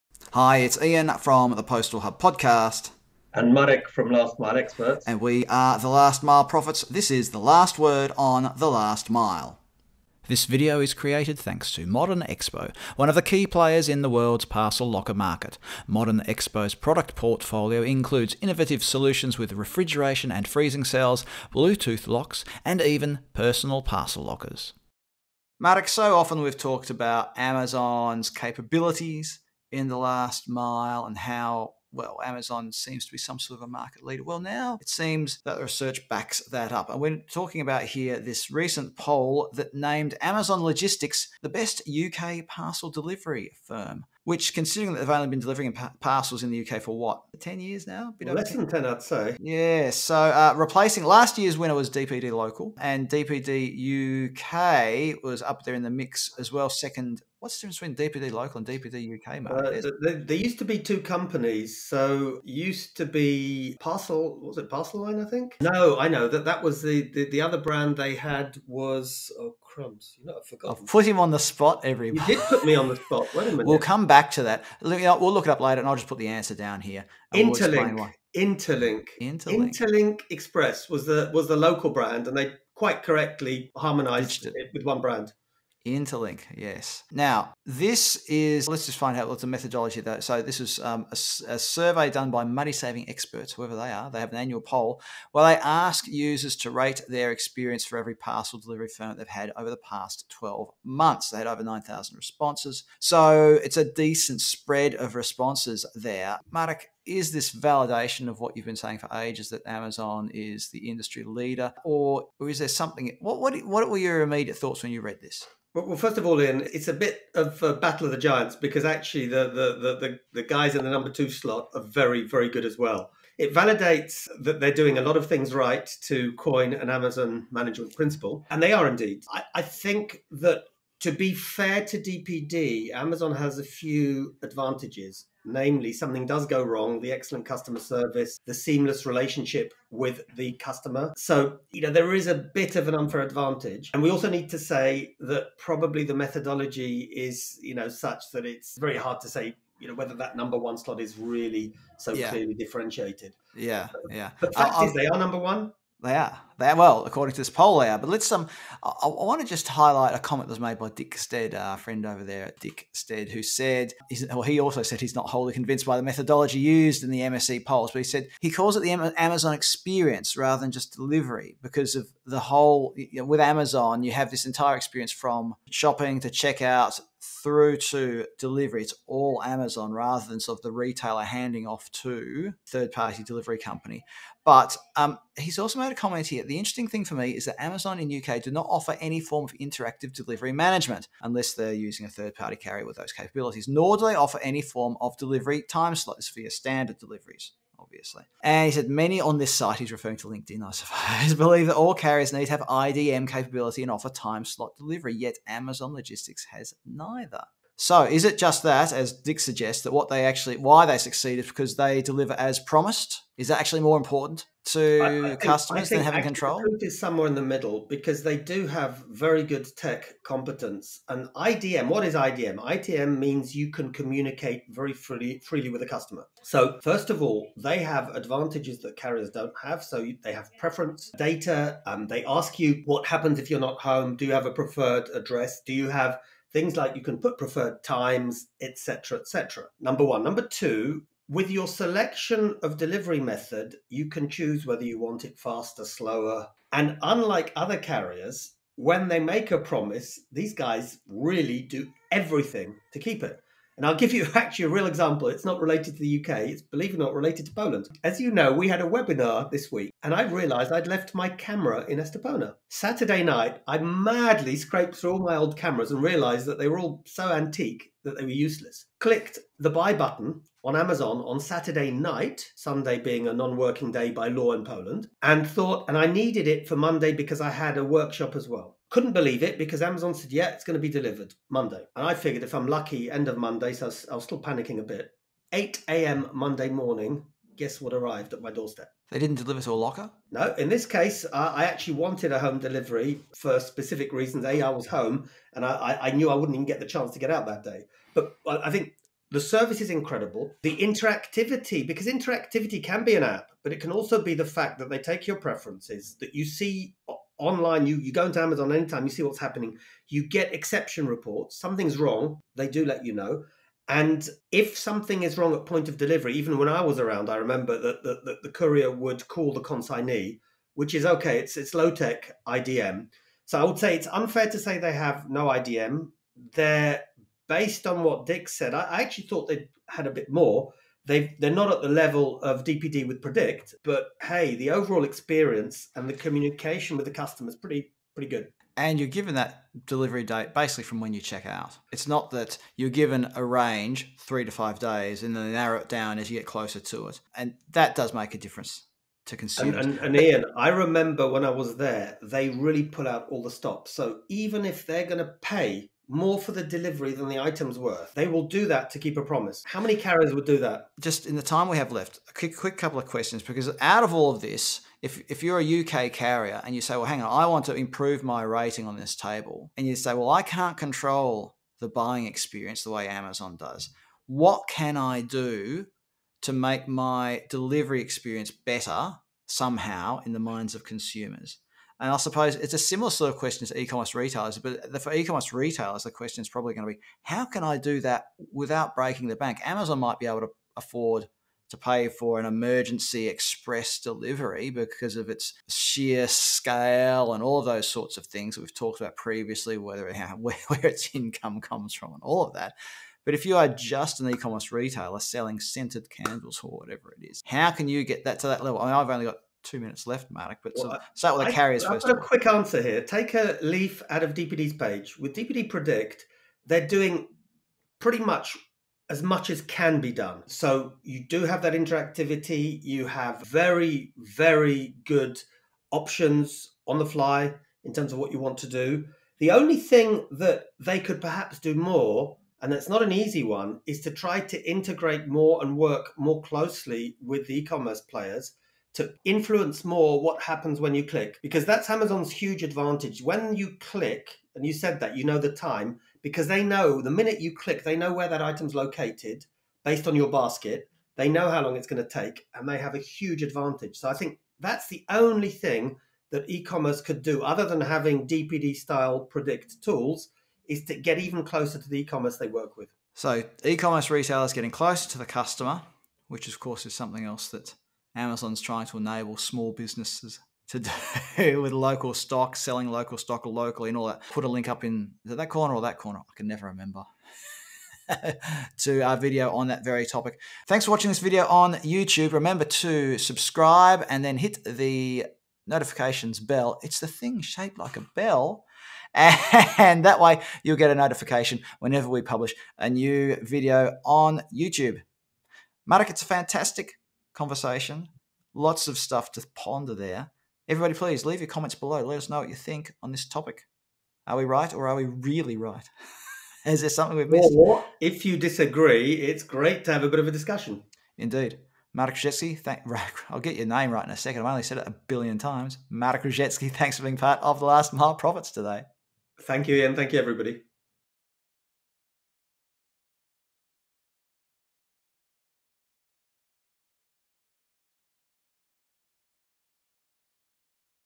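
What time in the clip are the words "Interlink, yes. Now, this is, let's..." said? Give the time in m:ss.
1:25.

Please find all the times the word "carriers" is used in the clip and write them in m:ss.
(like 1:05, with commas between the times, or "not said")
3:12, 3:21, 3:48, 4:07, 5:59, 6:06, 6:51.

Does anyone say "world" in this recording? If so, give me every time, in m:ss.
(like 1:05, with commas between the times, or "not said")
0:14.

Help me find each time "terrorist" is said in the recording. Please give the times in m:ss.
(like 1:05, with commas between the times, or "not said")
not said.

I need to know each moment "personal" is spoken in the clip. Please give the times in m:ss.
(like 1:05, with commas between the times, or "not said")
0:23.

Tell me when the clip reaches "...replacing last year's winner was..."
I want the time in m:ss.
0:50.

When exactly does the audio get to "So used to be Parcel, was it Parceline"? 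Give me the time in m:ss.
1:01.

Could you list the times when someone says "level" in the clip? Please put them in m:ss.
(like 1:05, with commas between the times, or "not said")
5:31, 6:48.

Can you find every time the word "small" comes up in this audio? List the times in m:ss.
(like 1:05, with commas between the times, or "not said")
7:49.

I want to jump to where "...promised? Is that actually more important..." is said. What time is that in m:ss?
3:32.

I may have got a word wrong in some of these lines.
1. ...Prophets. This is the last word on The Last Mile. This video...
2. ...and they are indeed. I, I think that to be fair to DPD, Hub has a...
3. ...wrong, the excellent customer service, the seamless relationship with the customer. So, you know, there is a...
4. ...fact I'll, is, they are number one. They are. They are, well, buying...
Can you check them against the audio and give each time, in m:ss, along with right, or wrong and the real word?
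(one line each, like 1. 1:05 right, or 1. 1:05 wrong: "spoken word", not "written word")
1. 0:06 right
2. 2:08 wrong: "Amazon", not "Hub"
3. 2:16 right
4. 2:34 wrong: "according", not "buying".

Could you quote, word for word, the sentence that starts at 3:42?
IDM means you can communicate very freely freely with a customer.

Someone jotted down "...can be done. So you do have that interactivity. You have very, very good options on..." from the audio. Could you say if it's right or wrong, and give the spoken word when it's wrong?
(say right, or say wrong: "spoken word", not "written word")
right.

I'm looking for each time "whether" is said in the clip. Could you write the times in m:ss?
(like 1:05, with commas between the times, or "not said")
2:29, 4:04, 6:39.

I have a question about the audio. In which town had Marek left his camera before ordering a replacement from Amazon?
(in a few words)
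Estepona.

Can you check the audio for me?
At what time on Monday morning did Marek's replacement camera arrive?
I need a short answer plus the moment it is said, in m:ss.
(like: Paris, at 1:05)
8 a.m., at 4:45.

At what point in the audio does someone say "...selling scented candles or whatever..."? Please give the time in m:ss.
6:45.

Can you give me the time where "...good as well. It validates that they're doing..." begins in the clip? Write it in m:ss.
2:02.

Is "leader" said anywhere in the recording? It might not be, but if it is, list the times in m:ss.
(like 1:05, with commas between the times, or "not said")
0:34, 1:51.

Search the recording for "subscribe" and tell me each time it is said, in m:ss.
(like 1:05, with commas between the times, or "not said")
8:03.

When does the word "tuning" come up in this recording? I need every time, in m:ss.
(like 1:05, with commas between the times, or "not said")
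not said.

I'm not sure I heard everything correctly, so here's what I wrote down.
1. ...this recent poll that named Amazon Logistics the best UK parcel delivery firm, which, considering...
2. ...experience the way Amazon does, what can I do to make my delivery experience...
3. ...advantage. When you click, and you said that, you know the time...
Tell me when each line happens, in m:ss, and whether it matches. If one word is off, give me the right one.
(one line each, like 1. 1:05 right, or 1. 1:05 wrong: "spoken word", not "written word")
1. 0:38 right
2. 6:12 right
3. 7:22 right.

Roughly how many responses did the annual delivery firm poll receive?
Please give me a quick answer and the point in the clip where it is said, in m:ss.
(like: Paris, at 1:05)
9,000, at 1:41.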